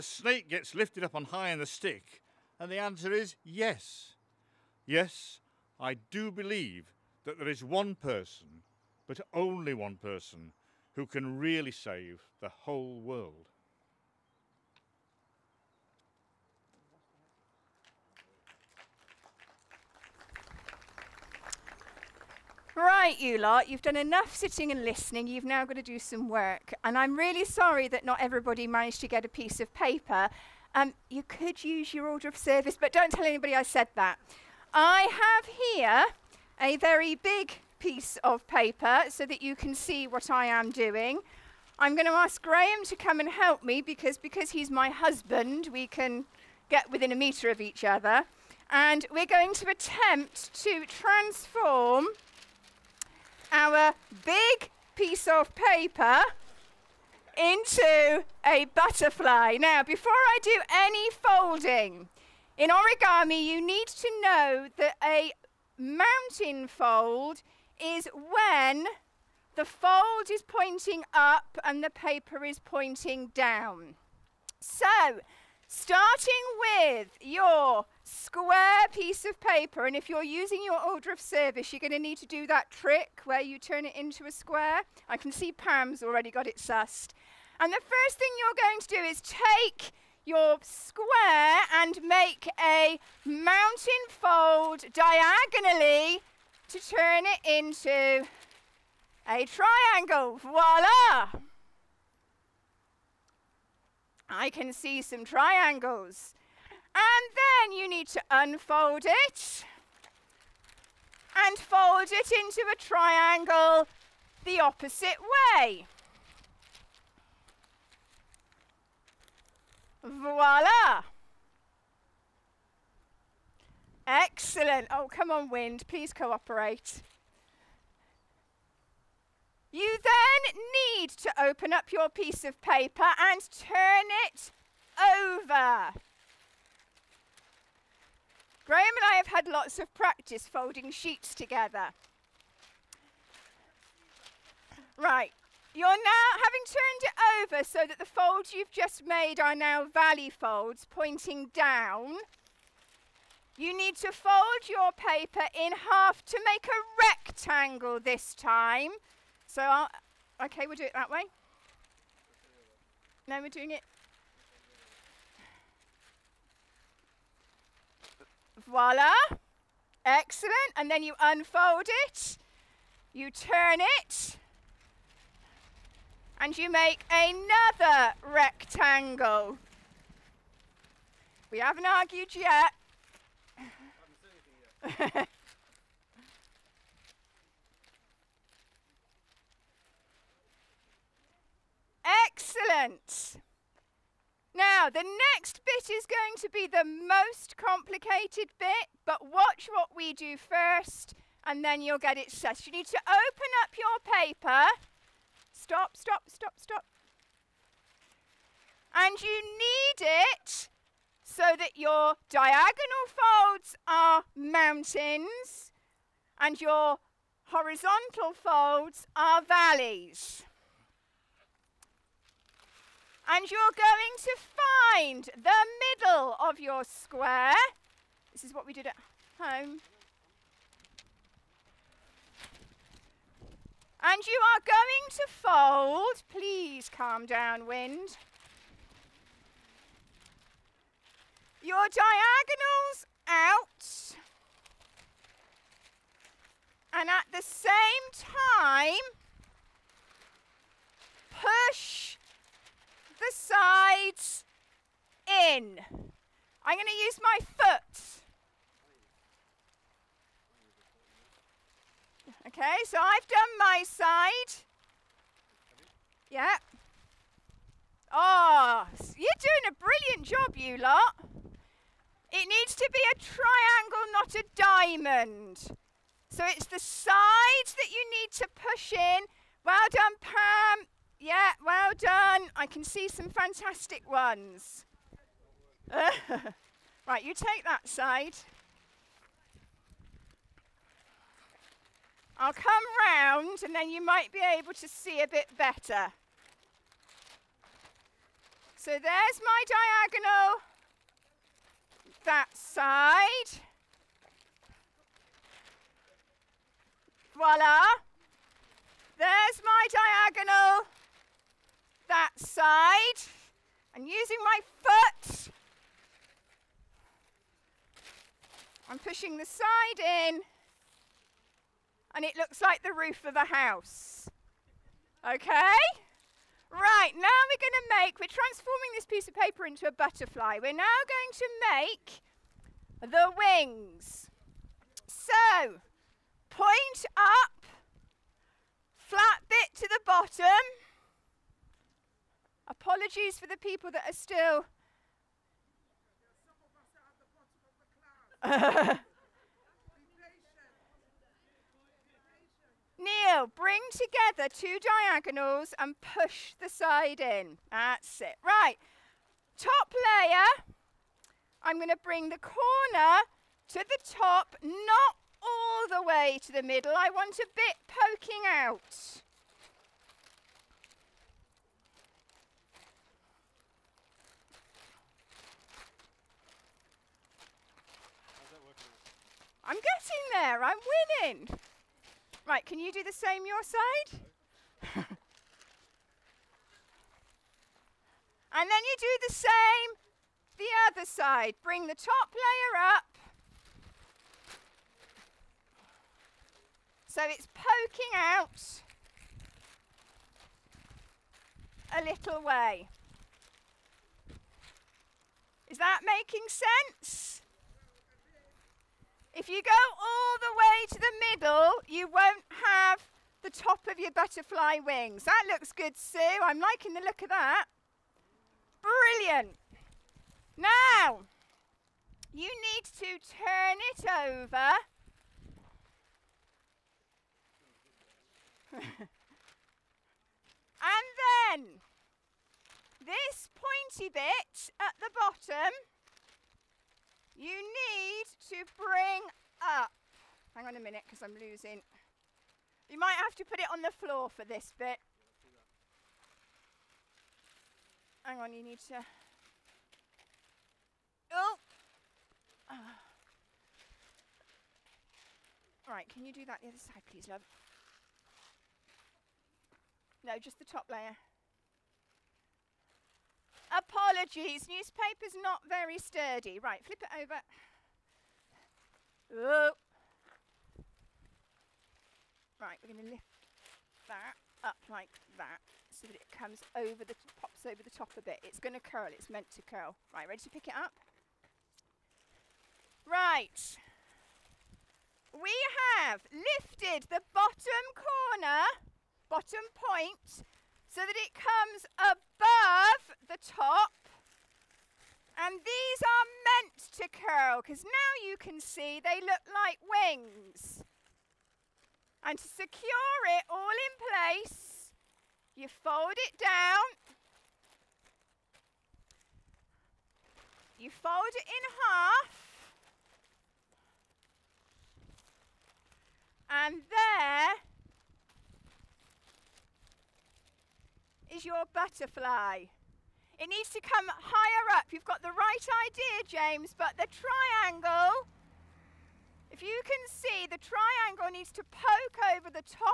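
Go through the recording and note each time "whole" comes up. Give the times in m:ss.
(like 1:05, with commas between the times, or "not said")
0:12.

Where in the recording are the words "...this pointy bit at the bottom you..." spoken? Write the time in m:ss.
7:12.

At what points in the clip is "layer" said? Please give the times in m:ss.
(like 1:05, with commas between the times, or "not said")
5:59, 6:32, 7:40.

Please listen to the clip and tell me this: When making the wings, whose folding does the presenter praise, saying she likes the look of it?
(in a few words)
Sue.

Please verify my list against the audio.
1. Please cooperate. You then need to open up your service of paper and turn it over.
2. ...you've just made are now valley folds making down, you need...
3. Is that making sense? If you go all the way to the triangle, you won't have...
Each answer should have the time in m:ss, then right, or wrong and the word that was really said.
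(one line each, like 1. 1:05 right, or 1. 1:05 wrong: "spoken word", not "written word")
1. 2:05 wrong: "piece", not "service"
2. 2:28 wrong: "pointing", not "making"
3. 6:45 wrong: "middle", not "triangle".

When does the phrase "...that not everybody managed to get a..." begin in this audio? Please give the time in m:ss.
0:27.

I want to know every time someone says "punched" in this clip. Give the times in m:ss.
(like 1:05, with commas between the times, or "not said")
not said.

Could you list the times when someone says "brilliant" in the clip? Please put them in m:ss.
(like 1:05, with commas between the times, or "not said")
4:29, 6:58.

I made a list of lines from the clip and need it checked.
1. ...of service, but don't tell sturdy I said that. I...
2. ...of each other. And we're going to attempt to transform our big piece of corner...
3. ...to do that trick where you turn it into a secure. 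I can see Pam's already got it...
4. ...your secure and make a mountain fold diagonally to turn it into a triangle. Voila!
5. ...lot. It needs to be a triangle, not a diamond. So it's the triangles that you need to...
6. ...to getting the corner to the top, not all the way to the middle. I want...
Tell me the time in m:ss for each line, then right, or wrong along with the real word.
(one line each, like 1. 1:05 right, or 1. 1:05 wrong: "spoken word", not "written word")
1. 0:32 wrong: "anybody", not "sturdy"
2. 0:47 wrong: "paper", not "corner"
3. 1:22 wrong: "square", not "secure"
4. 1:30 wrong: "square", not "secure"
5. 4:30 wrong: "sides", not "triangles"
6. 6:01 wrong: "bring", not "getting".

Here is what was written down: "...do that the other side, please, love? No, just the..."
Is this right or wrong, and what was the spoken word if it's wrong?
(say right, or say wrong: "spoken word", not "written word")
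right.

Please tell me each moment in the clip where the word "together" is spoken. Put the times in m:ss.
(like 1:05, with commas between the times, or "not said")
2:21, 5:53.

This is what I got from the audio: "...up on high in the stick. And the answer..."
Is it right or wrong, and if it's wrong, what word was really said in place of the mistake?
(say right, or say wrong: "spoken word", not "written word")
right.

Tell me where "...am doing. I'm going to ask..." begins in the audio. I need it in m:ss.
0:40.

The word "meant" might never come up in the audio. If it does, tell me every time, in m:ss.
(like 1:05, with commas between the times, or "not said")
7:59, 8:16.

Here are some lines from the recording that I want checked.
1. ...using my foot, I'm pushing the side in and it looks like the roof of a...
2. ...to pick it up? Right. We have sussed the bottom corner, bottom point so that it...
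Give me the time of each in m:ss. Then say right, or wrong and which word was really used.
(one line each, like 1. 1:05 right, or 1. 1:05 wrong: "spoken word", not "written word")
1. 5:14 right
2. 8:00 wrong: "lifted", not "sussed".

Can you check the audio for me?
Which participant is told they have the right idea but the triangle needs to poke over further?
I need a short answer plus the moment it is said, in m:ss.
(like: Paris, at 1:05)
James, at 8:46.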